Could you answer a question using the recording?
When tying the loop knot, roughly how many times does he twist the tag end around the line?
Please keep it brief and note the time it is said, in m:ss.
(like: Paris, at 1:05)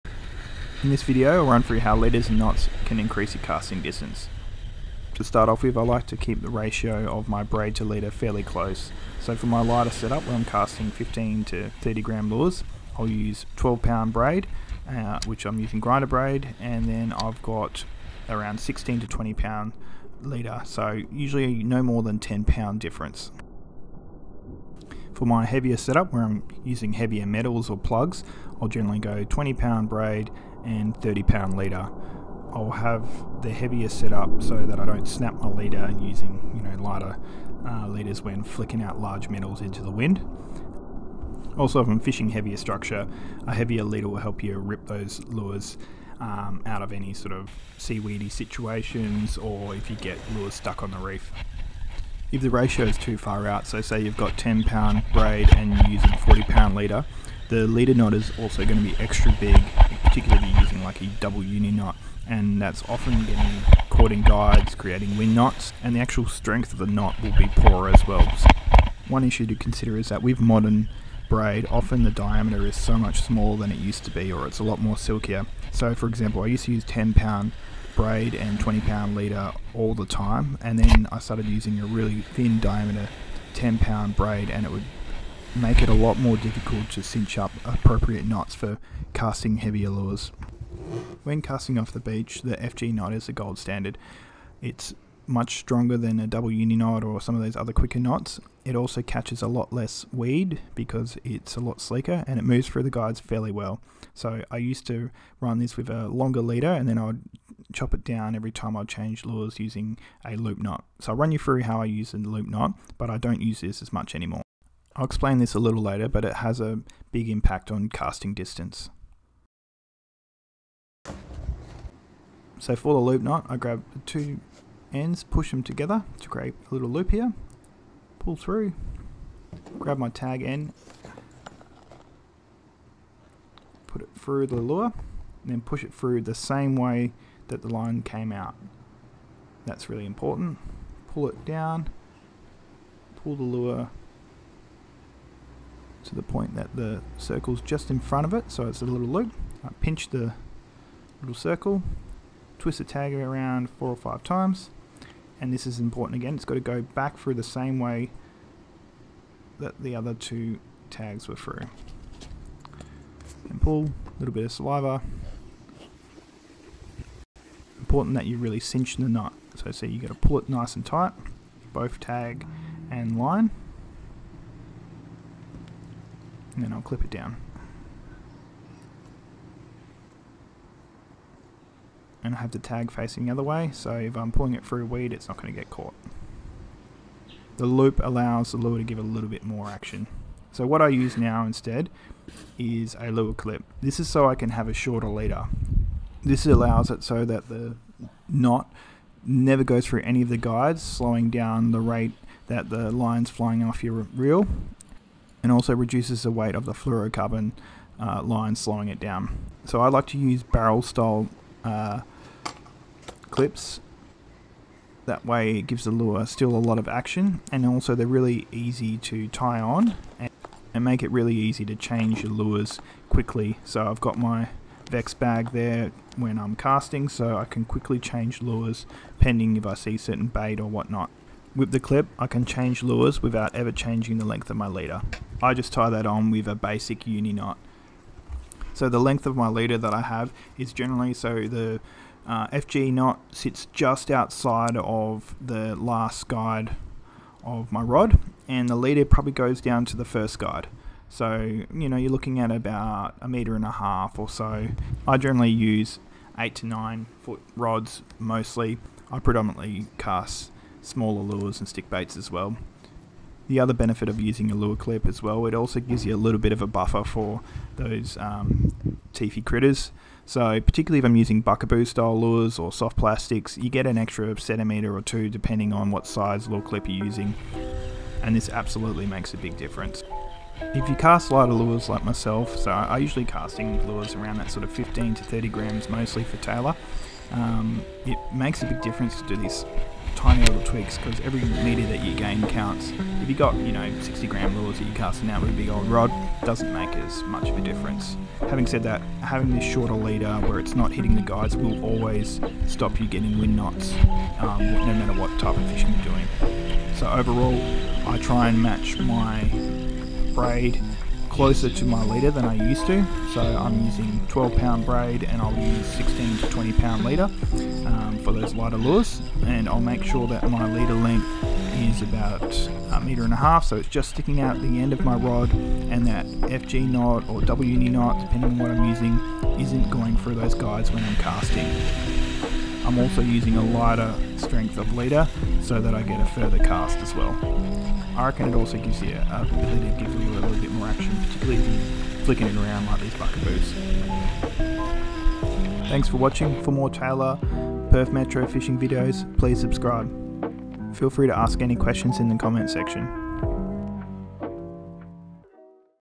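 4 or 5, at 2:33.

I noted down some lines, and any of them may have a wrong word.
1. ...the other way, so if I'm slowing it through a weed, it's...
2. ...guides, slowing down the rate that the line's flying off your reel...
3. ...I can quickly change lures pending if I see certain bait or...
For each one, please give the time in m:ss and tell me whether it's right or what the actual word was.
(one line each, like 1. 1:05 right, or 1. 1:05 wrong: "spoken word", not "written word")
1. 3:03 wrong: "pulling", not "slowing"
2. 3:20 right
3. 3:47 right.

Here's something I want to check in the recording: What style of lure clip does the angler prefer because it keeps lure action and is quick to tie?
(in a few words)
Barrel style.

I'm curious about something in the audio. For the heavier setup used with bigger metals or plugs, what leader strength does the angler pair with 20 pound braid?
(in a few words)
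30 pound.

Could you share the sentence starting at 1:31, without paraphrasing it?
When casting off the beach, the FG knot is the gold standard.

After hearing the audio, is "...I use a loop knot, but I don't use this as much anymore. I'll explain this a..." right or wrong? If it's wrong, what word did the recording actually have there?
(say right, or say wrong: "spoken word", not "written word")
right.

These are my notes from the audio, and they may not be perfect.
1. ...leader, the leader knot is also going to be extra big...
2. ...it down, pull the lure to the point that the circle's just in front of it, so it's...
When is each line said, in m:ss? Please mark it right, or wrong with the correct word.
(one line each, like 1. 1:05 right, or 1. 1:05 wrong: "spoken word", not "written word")
1. 0:56 right
2. 2:21 right.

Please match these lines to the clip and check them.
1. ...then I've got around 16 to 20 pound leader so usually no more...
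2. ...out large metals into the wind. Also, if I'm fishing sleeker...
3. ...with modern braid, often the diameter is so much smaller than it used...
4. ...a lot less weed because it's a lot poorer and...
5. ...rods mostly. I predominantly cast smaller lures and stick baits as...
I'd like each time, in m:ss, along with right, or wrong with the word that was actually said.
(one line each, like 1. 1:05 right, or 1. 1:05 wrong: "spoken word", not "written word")
1. 0:16 right
2. 0:38 wrong: "heavier", not "sleeker"
3. 1:10 right
4. 1:39 wrong: "sleeker", not "poorer"
5. 4:17 right.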